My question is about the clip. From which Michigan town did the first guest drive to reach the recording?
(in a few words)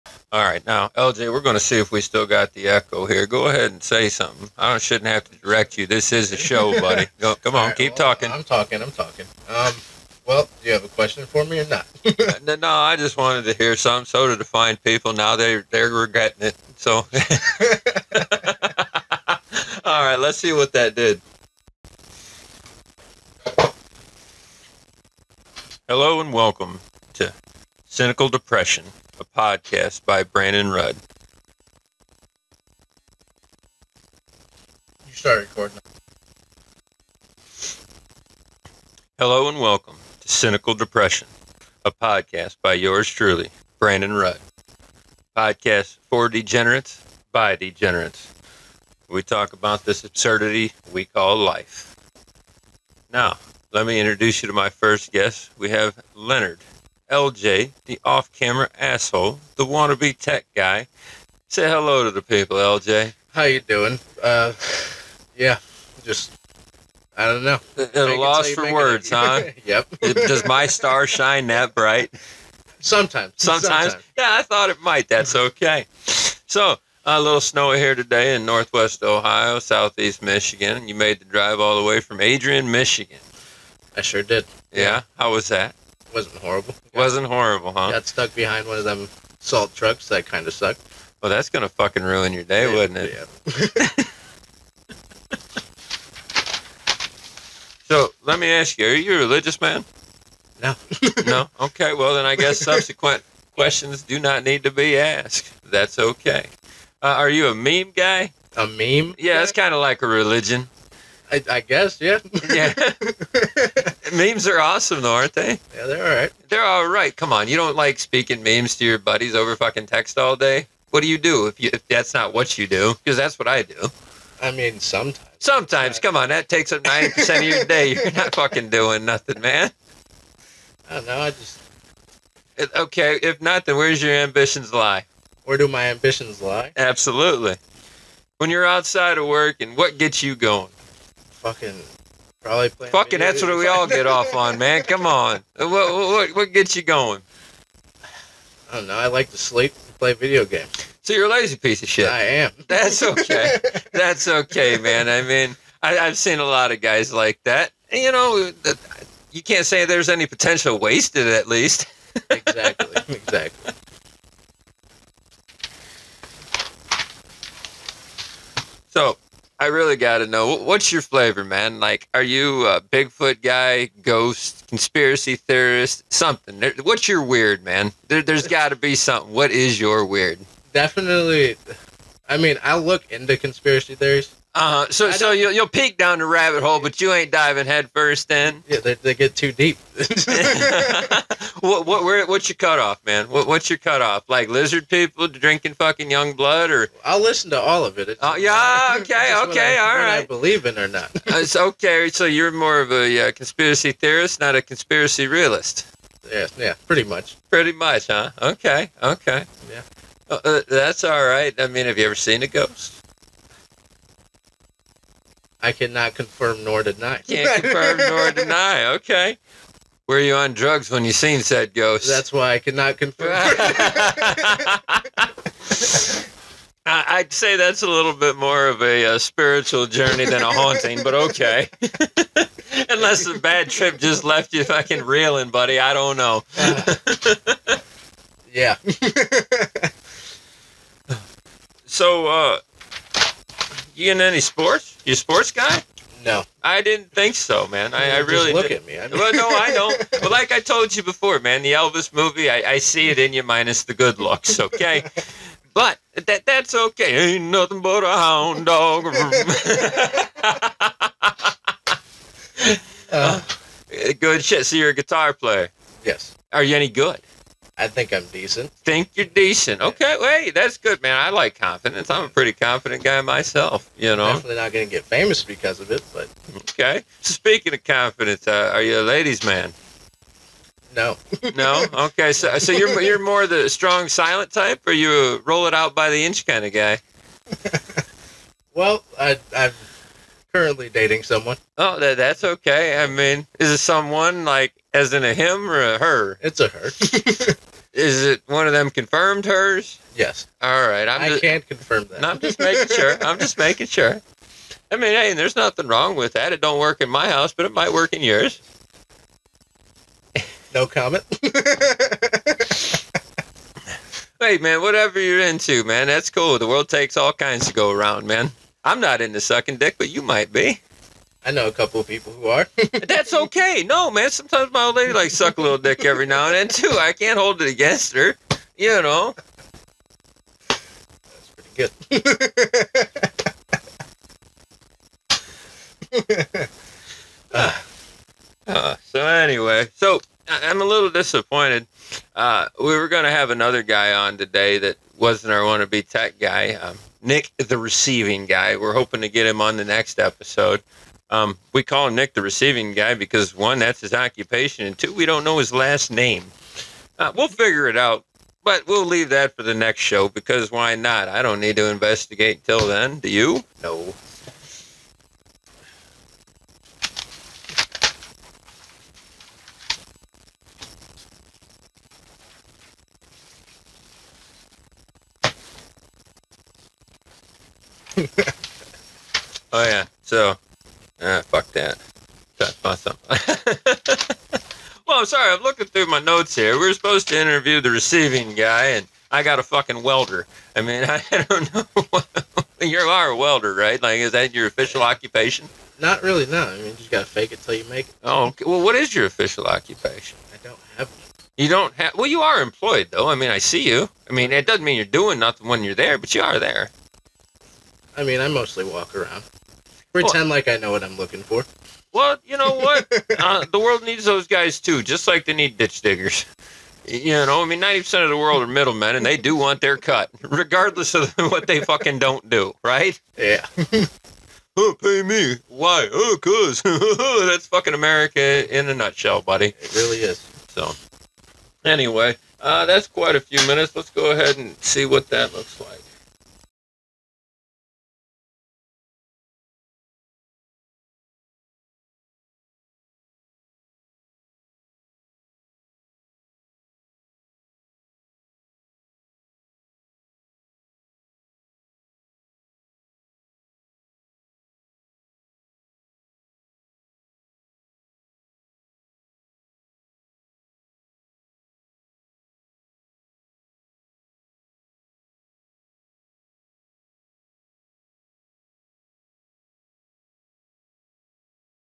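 Adrian.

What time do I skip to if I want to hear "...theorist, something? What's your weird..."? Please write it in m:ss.
2:55.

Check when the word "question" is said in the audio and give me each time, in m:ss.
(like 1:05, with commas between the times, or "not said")
0:10, 1:43.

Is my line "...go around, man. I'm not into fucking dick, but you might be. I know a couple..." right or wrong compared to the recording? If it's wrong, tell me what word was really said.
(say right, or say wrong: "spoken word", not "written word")
wrong: "sucking", not "fucking".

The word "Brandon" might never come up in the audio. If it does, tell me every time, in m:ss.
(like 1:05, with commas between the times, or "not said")
0:30, 0:43.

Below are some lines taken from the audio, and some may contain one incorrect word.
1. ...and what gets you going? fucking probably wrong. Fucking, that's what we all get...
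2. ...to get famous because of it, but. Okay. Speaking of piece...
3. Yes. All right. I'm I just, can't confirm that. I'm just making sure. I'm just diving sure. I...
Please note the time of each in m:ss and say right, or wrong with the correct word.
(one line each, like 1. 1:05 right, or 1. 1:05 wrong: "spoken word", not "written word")
1. 2:19 wrong: "playing", not "wrong"
2. 4:34 wrong: "confidence", not "piece"
3. 5:00 wrong: "making", not "diving".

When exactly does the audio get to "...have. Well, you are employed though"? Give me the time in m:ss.
6:41.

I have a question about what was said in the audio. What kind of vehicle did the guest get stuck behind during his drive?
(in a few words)
salt trucks.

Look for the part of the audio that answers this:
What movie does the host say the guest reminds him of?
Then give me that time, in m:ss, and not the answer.
4:11.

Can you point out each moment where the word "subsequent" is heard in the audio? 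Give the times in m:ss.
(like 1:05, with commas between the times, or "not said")
1:42.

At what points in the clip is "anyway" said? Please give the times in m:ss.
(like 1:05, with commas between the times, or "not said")
5:39, 7:11.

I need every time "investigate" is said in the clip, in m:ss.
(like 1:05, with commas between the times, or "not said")
6:01.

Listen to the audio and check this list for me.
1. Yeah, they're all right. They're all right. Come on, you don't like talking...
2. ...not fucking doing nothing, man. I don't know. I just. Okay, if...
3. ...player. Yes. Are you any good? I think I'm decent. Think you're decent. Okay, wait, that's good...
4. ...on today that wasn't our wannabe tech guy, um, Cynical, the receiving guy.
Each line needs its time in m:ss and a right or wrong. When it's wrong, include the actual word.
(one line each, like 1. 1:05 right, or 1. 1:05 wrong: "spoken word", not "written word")
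1. 1:55 wrong: "speaking", not "talking"
2. 2:08 right
3. 4:25 right
4. 5:44 wrong: "Nick", not "Cynical".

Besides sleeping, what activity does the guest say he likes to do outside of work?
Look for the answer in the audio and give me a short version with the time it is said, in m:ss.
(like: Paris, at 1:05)
play video games, at 2:29.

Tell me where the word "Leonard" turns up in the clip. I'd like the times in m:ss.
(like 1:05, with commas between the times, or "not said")
0:56.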